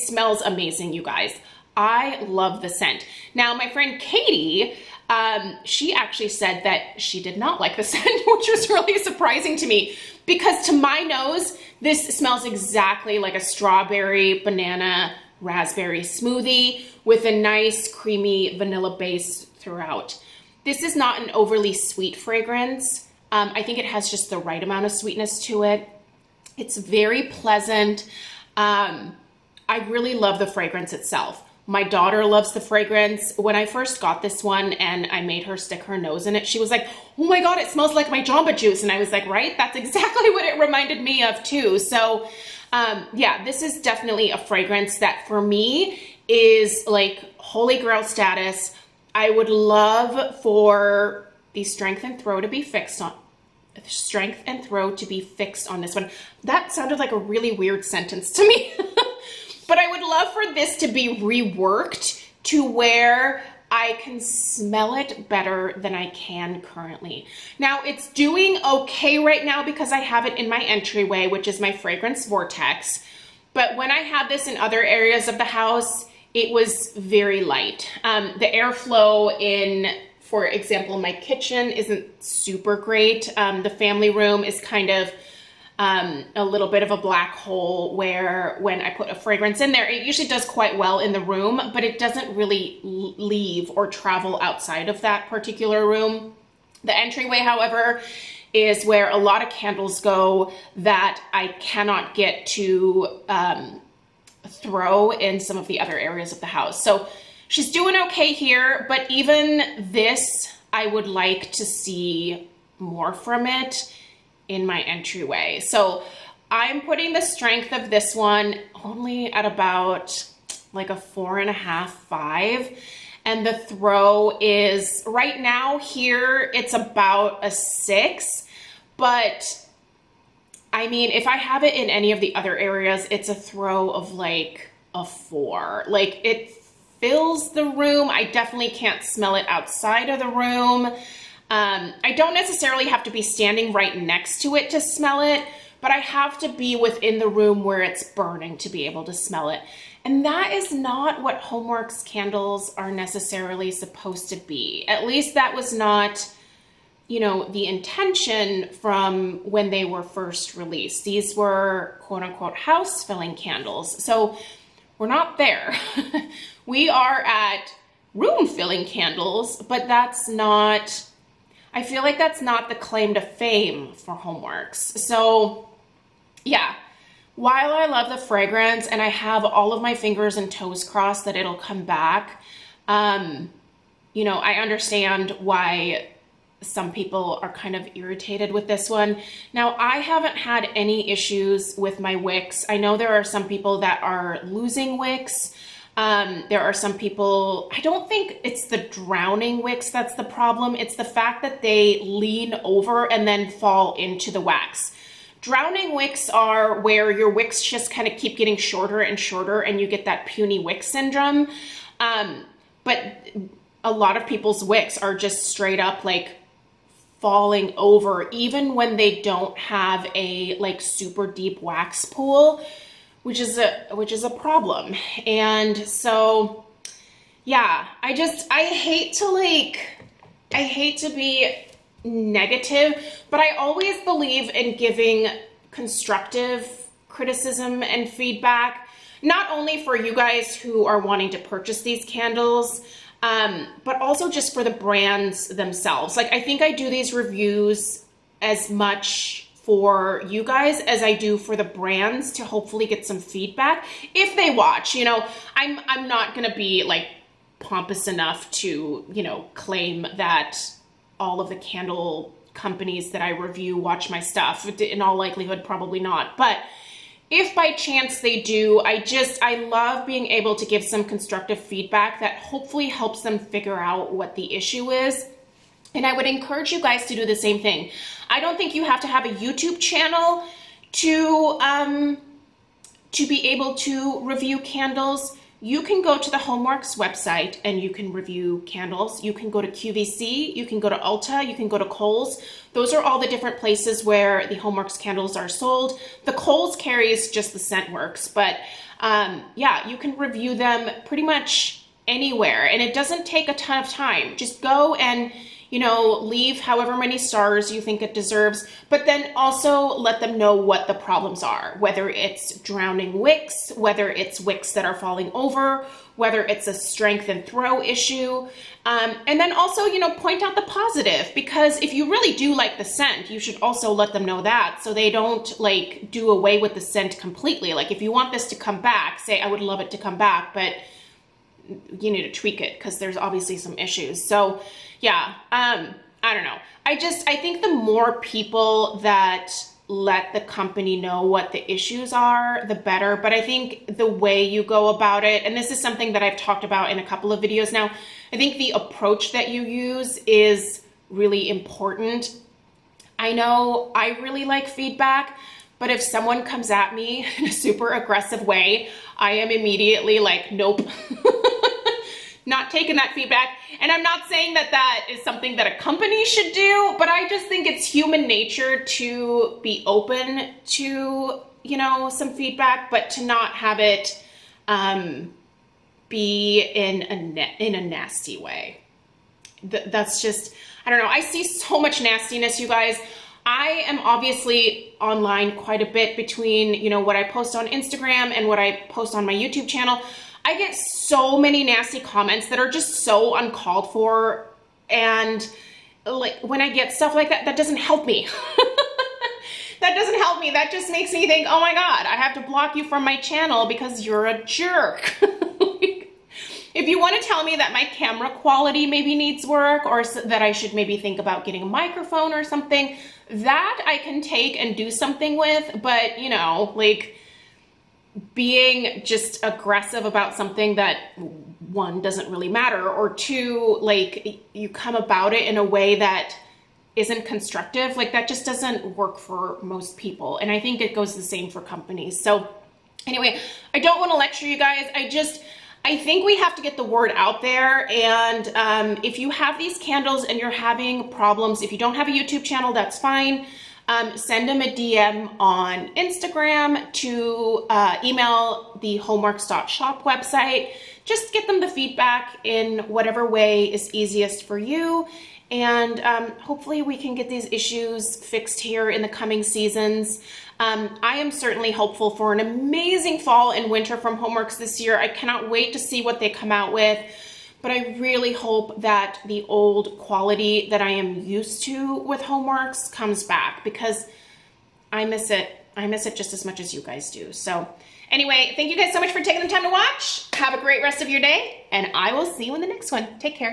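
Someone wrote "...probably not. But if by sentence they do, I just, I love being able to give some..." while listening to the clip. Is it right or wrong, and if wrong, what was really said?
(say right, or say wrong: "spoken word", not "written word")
wrong: "chance", not "sentence".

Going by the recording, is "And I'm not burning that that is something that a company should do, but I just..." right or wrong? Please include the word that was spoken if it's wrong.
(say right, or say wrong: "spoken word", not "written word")
wrong: "saying", not "burning".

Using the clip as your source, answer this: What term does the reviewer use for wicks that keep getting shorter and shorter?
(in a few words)
puny wick syndrome.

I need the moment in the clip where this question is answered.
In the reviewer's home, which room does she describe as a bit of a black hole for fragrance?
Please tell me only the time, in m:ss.
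1:23.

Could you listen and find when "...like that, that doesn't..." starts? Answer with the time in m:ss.
6:37.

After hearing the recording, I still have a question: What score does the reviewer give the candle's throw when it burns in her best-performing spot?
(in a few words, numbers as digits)
6.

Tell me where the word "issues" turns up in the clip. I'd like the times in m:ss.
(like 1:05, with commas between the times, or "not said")
3:11, 4:34, 5:17, 5:33, 5:41, 7:37.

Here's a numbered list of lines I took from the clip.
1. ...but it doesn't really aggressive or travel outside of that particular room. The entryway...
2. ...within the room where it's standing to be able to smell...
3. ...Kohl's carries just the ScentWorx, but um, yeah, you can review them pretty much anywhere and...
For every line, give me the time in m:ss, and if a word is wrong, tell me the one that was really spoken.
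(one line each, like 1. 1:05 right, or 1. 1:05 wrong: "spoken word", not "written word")
1. 1:31 wrong: "leave", not "aggressive"
2. 2:26 wrong: "burning", not "standing"
3. 4:56 right.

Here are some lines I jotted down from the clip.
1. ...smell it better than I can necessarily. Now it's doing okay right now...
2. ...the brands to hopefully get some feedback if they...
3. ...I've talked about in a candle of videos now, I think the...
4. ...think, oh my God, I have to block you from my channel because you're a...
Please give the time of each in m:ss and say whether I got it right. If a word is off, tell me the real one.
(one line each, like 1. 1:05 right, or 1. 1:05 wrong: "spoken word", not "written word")
1. 1:04 wrong: "currently", not "necessarily"
2. 4:11 right
3. 5:46 wrong: "couple", not "candle"
4. 6:41 right.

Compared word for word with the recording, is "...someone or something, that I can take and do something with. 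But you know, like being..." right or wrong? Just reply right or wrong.
wrong.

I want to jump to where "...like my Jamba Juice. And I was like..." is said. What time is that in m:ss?
0:37.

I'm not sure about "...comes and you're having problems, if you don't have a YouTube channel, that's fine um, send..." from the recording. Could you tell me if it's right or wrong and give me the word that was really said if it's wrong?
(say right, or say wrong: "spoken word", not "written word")
wrong: "candles", not "comes".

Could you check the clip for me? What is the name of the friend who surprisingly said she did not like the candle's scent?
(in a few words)
Katie.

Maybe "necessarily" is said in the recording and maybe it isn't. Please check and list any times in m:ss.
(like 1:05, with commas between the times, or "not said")
2:22, 2:32.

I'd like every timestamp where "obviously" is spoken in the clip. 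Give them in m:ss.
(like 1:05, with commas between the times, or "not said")
5:33, 6:23.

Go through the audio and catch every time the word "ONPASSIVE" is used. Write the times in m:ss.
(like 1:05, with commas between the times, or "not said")
not said.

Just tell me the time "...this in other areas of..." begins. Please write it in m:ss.
1:14.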